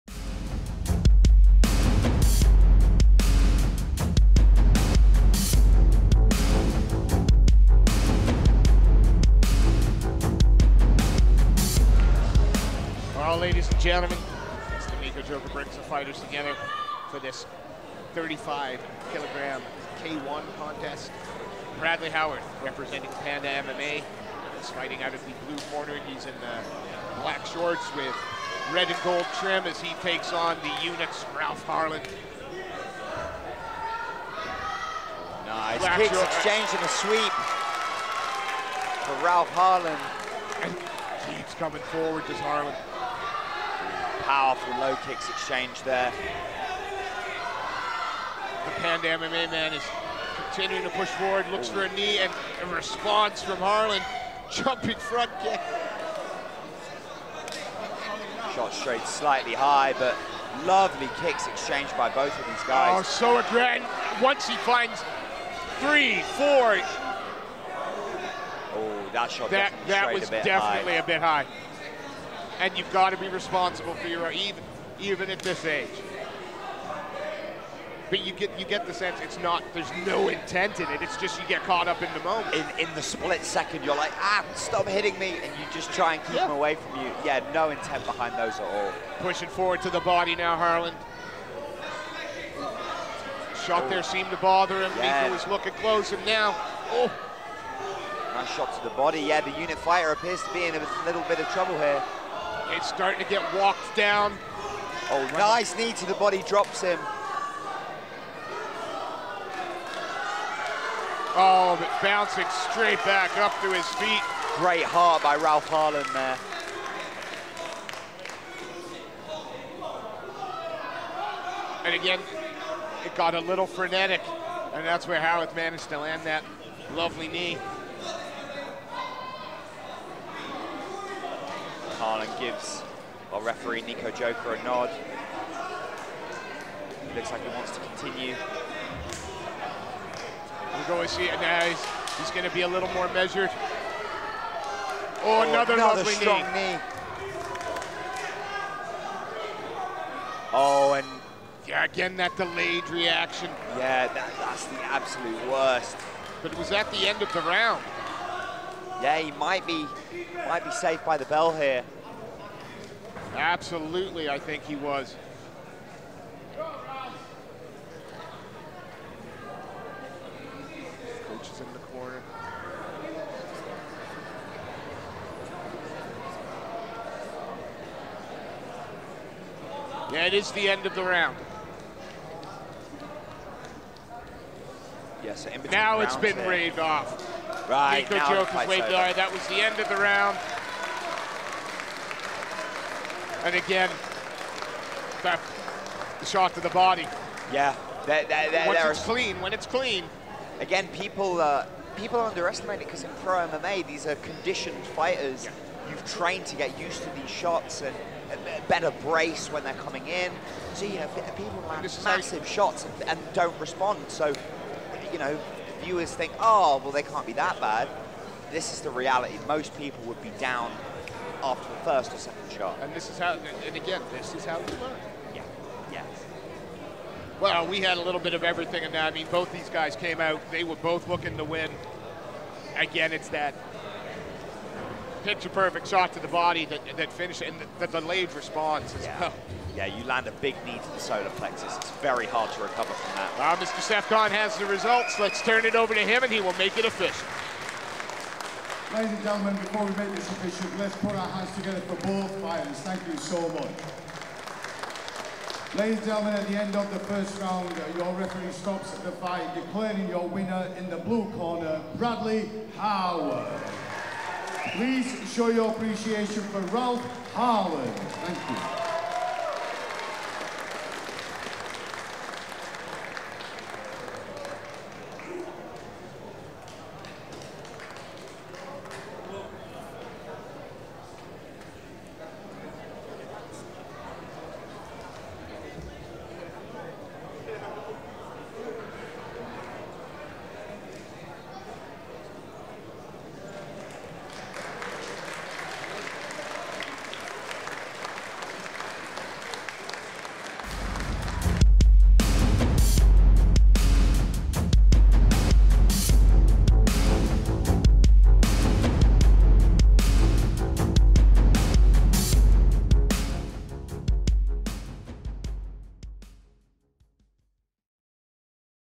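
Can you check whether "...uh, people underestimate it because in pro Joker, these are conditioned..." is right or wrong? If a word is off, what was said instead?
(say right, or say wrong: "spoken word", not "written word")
wrong: "MMA", not "Joker".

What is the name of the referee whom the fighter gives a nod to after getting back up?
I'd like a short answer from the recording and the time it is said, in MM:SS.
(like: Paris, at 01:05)
Nico Joker, at 02:13.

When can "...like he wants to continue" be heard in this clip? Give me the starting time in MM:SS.
02:17.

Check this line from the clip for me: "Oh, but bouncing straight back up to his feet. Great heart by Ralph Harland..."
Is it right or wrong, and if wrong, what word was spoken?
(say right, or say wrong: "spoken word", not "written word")
right.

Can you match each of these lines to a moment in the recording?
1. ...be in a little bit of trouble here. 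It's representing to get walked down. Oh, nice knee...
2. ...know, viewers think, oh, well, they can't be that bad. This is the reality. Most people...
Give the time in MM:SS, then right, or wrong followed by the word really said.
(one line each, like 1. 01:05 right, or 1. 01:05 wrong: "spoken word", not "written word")
1. 01:40 wrong: "starting", not "representing"
2. 03:35 right.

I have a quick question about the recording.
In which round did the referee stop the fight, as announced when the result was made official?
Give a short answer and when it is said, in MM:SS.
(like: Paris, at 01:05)
first round, at 04:16.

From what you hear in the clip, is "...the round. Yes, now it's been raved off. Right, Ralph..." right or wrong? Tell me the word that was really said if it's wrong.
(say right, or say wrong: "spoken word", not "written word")
wrong: "Nico", not "Ralph".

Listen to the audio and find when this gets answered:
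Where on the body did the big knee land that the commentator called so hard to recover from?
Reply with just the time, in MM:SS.
04:00.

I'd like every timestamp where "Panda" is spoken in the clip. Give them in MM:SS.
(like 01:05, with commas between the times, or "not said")
00:23, 00:48.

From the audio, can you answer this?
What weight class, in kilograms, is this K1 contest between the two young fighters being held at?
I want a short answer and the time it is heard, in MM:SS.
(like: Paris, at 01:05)
35, at 00:18.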